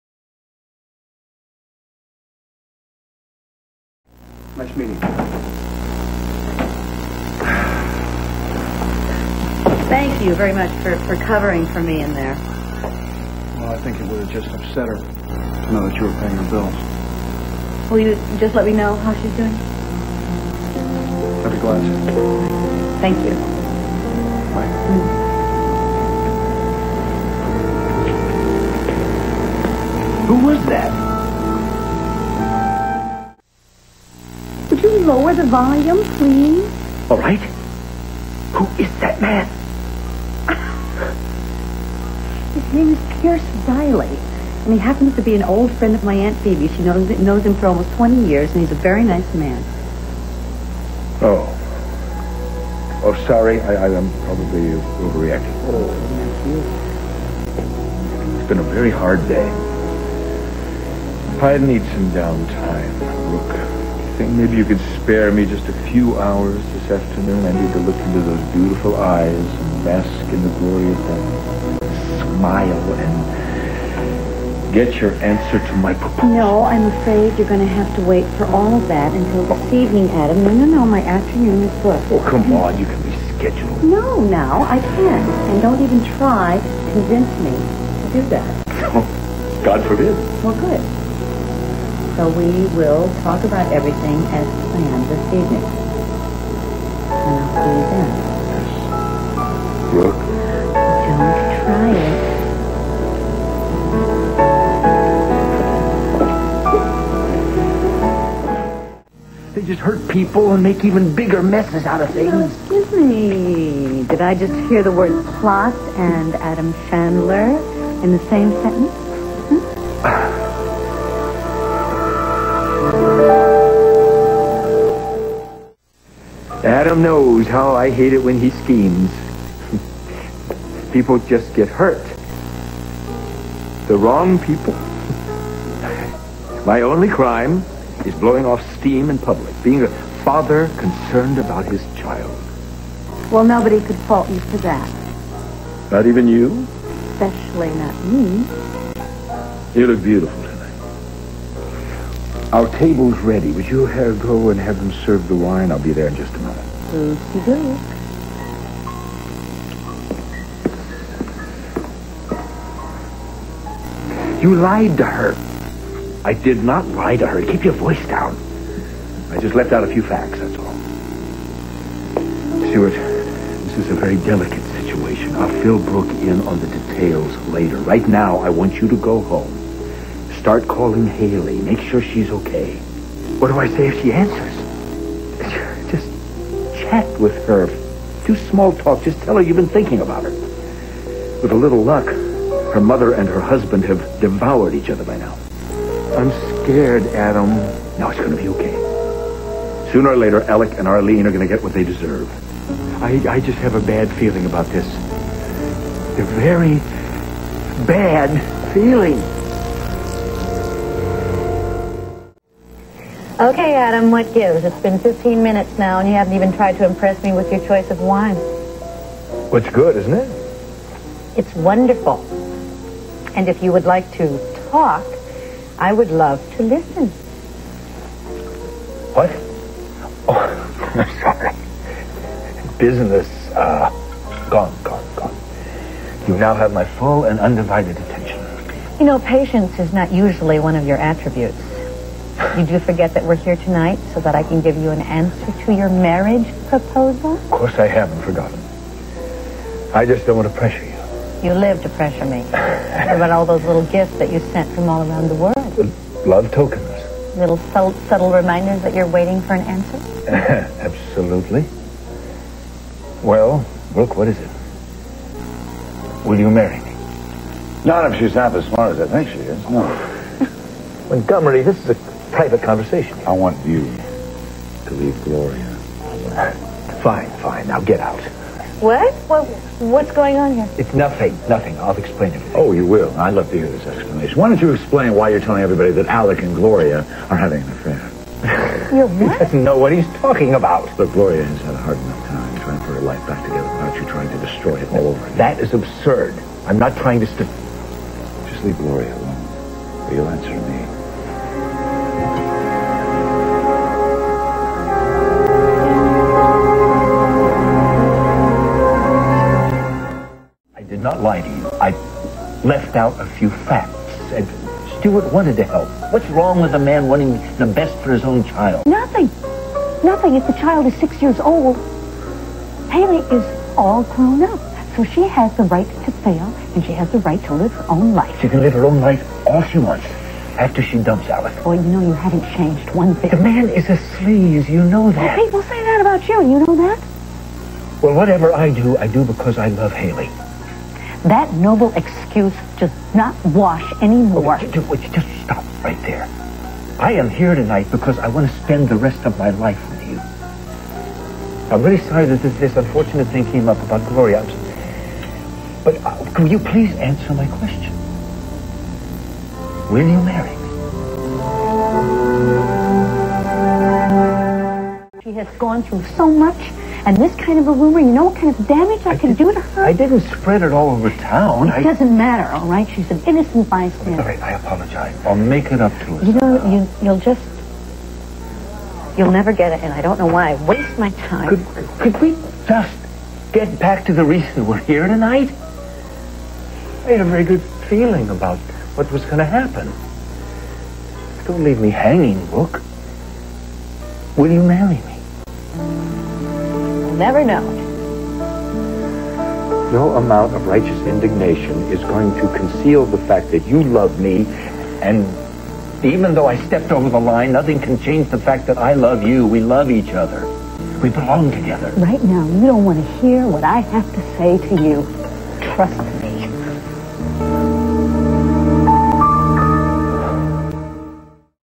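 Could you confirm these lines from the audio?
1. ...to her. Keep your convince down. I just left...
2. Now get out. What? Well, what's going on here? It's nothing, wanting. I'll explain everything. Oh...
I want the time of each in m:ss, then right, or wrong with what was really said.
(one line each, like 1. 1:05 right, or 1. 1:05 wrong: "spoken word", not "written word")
1. 2:47 wrong: "voice", not "convince"
2. 4:37 wrong: "nothing", not "wanting".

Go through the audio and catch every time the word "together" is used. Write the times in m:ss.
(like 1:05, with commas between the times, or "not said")
4:53, 6:51.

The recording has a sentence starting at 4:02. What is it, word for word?
You do forget that we're here tonight so that I can give you an answer to your marriage proposal?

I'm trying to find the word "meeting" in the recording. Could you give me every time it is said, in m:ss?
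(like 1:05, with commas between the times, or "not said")
0:04.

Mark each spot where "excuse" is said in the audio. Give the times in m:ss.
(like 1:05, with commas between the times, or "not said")
1:52, 5:41.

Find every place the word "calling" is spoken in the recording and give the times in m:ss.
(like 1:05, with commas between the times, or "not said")
3:00.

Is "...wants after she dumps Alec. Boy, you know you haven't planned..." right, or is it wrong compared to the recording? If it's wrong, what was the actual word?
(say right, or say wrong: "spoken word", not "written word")
wrong: "changed", not "planned".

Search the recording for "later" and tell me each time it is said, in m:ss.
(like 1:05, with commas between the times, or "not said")
2:57, 3:20.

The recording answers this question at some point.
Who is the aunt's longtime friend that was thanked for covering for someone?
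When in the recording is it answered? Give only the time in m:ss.
0:43.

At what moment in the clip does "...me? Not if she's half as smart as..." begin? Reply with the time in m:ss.
4:26.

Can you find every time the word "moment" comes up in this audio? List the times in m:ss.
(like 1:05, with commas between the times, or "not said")
2:36.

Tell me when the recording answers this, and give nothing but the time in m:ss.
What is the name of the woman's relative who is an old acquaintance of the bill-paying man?
0:46.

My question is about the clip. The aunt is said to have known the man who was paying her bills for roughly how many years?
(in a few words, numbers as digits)
20.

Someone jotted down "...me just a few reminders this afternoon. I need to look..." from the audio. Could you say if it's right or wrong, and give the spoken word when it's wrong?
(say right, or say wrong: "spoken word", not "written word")
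wrong: "hours", not "reminders".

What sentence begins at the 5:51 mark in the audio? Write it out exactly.
I'm really sorry that this, this unfortunate thing came up about Gloria.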